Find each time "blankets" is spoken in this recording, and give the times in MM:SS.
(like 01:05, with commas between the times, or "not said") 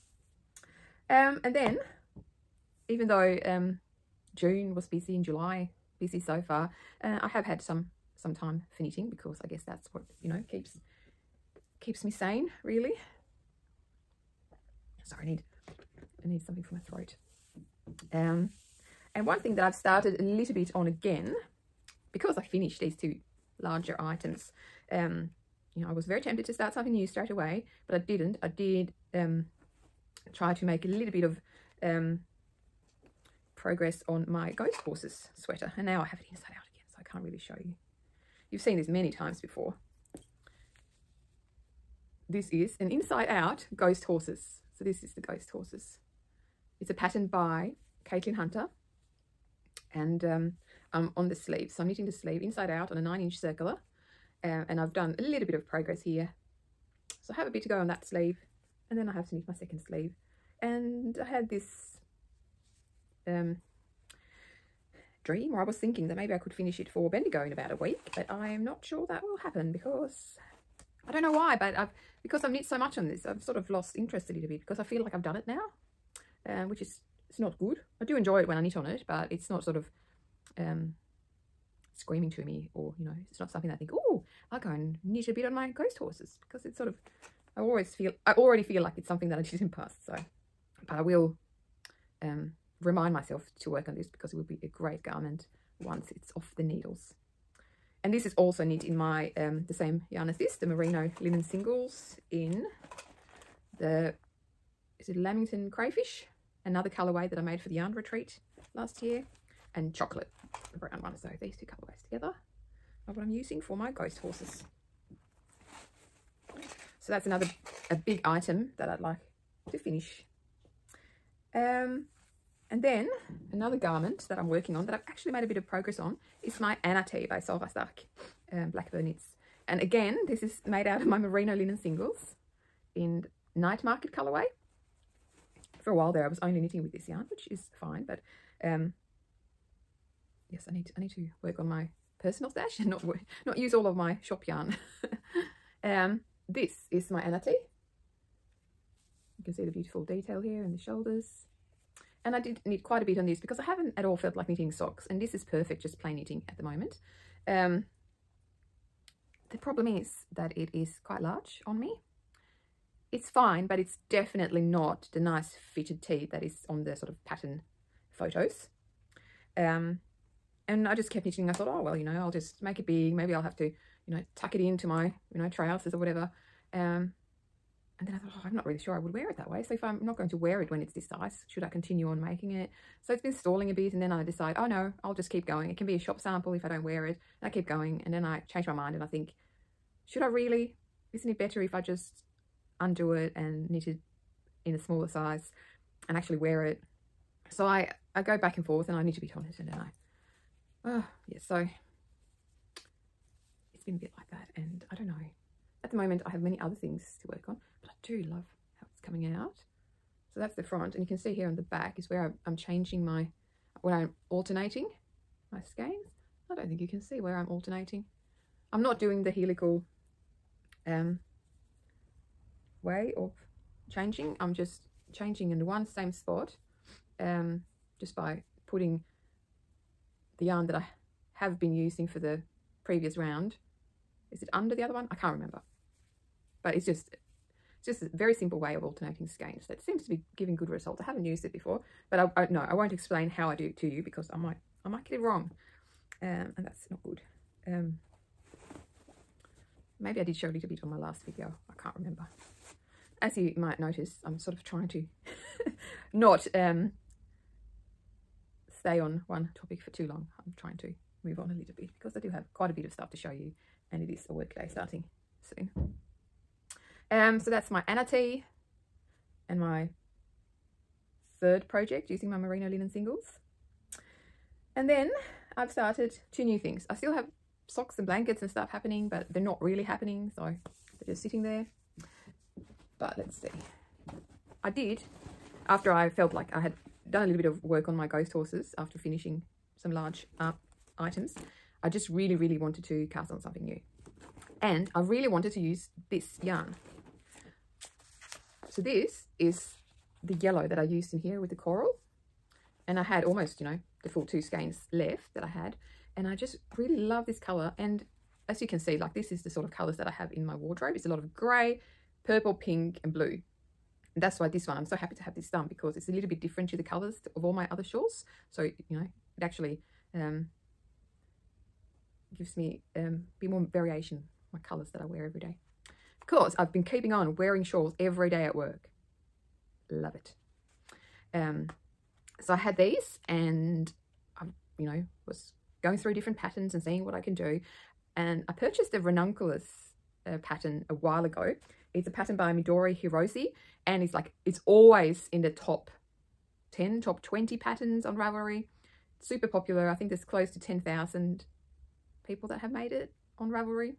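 04:38.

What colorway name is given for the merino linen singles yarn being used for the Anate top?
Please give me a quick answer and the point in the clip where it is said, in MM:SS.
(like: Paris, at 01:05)
Night Market, at 02:13.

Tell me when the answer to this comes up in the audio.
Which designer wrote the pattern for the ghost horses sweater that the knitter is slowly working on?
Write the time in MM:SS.
00:48.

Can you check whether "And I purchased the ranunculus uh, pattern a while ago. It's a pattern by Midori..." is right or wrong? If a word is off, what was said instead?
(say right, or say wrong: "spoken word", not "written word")
right.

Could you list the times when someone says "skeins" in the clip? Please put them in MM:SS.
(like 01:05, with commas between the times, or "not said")
03:35, 03:59, 05:04.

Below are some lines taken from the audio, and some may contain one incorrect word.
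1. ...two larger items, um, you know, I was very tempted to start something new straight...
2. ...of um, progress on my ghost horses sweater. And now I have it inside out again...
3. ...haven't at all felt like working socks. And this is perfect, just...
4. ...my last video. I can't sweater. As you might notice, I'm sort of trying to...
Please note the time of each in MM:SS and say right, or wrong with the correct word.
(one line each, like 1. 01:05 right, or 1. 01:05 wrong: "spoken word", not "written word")
1. 00:22 right
2. 00:31 right
3. 02:33 wrong: "knitting", not "working"
4. 04:10 wrong: "remember", not "sweater".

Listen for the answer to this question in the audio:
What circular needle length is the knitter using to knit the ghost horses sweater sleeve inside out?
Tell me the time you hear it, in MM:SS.
00:53.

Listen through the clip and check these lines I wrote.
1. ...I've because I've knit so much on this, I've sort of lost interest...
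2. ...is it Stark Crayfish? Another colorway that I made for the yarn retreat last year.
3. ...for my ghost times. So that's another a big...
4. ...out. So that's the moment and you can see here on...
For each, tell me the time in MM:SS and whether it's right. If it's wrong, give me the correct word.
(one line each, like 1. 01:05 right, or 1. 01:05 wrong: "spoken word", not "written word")
1. 01:11 right
2. 01:44 wrong: "Lamington", not "Stark"
3. 01:53 wrong: "horses", not "times"
4. 03:29 wrong: "front", not "moment".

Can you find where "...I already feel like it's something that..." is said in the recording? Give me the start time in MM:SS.
01:28.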